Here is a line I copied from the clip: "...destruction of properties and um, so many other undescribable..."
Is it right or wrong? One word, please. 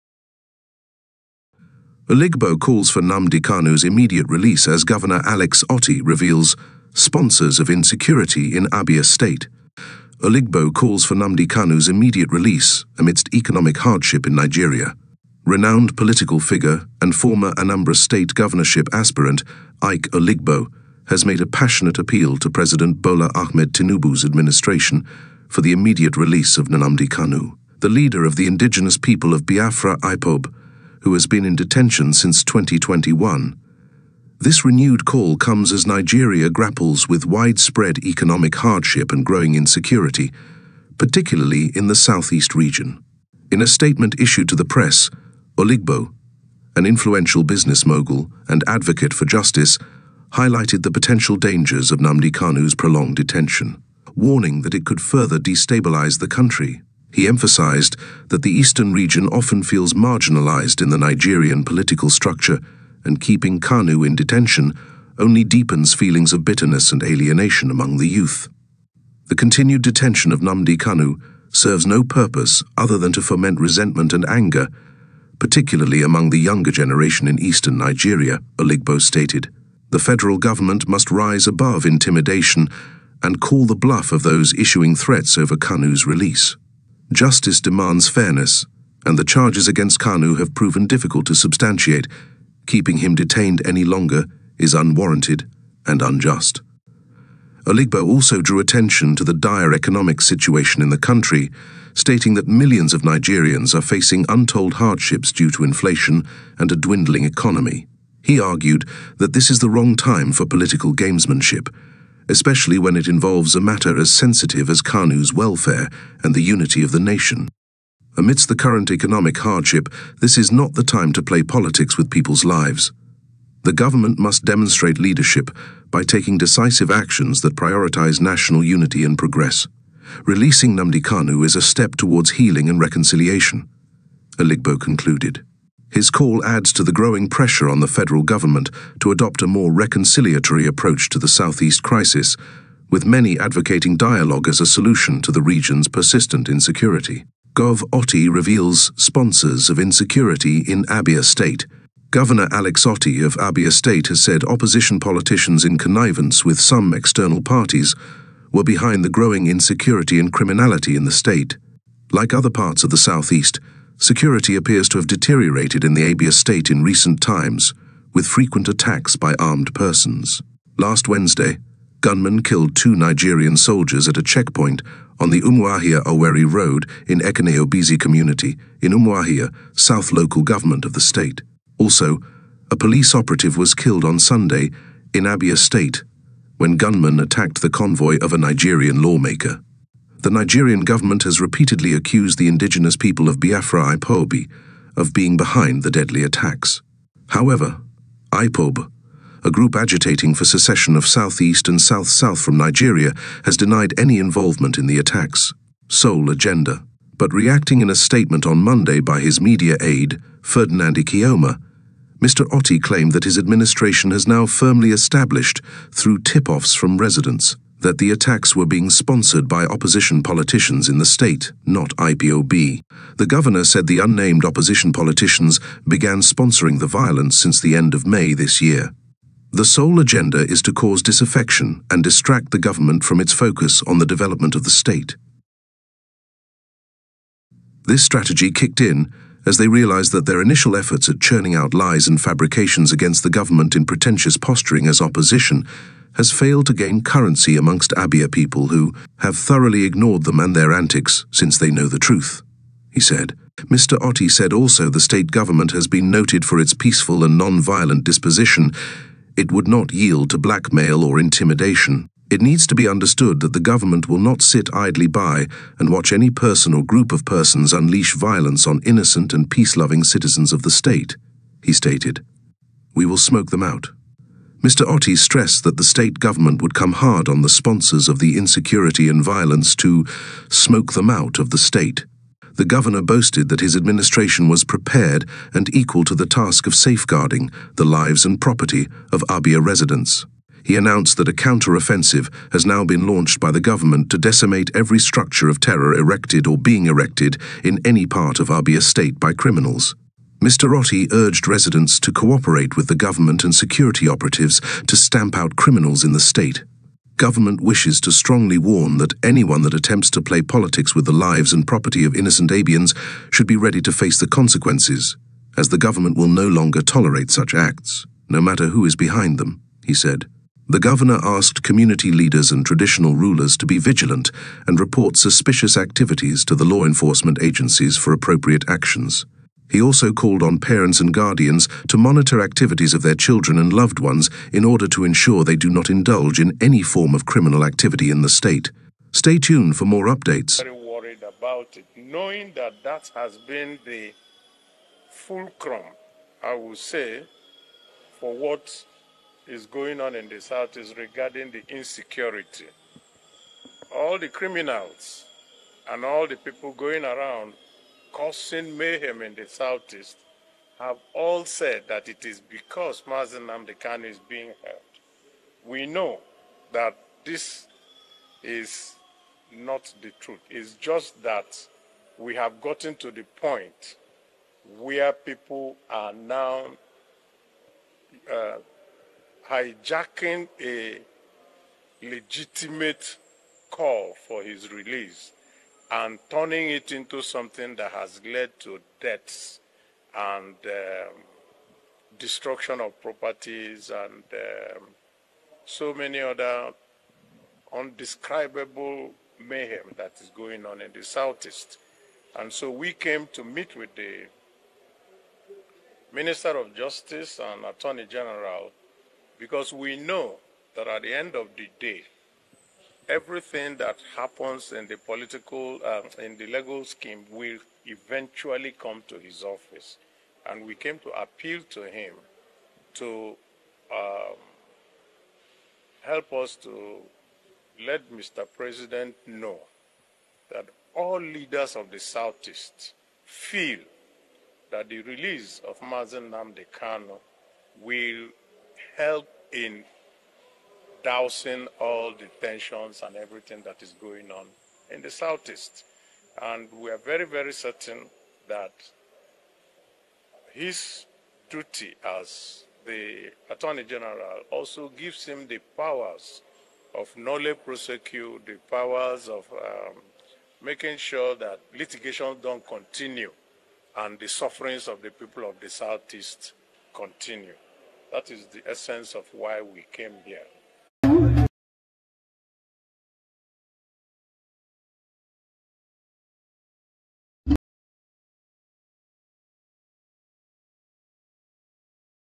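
right.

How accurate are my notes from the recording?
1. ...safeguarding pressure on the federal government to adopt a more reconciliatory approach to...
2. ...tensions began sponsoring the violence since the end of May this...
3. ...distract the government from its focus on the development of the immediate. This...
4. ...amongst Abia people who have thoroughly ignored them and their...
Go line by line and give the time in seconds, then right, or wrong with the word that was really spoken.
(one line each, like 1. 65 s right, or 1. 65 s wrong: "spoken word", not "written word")
1. 136 s wrong: "growing", not "safeguarding"
2. 224 s wrong: "politicians", not "tensions"
3. 232 s wrong: "state", not "immediate"
4. 247 s right.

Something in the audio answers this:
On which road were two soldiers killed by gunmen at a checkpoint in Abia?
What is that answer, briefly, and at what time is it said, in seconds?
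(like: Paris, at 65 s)
Umuahia Owerri Road, at 175 s.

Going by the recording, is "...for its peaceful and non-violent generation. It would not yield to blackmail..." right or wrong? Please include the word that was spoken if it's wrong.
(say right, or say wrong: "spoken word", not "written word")
wrong: "disposition", not "generation".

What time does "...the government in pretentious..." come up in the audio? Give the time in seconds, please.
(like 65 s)
243 s.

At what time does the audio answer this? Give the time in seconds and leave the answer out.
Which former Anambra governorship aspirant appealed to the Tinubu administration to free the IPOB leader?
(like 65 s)
19 s.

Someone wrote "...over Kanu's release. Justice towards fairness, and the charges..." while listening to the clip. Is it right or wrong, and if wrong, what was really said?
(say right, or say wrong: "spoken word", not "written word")
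wrong: "demands", not "towards".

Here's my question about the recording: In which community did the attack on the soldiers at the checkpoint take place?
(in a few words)
Obisi.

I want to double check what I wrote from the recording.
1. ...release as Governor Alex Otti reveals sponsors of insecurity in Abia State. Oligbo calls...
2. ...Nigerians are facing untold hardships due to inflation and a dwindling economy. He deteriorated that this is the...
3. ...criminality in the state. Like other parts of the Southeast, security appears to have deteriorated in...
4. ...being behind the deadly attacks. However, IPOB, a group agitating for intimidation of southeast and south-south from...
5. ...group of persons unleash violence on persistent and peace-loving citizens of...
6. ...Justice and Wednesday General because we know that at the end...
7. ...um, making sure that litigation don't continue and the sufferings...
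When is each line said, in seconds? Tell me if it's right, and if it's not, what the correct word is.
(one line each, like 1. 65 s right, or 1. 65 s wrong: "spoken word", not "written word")
1. 4 s right
2. 103 s wrong: "argued", not "deteriorated"
3. 160 s right
4. 195 s wrong: "secession", not "intimidation"
5. 266 s wrong: "innocent", not "persistent"
6. 406 s wrong: "Attorney", not "Wednesday"
7. 459 s right.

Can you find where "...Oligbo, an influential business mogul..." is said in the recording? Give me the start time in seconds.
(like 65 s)
45 s.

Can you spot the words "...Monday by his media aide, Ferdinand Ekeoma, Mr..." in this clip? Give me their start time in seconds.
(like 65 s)
208 s.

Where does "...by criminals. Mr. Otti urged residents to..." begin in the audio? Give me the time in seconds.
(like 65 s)
299 s.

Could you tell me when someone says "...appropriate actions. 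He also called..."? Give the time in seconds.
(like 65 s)
328 s.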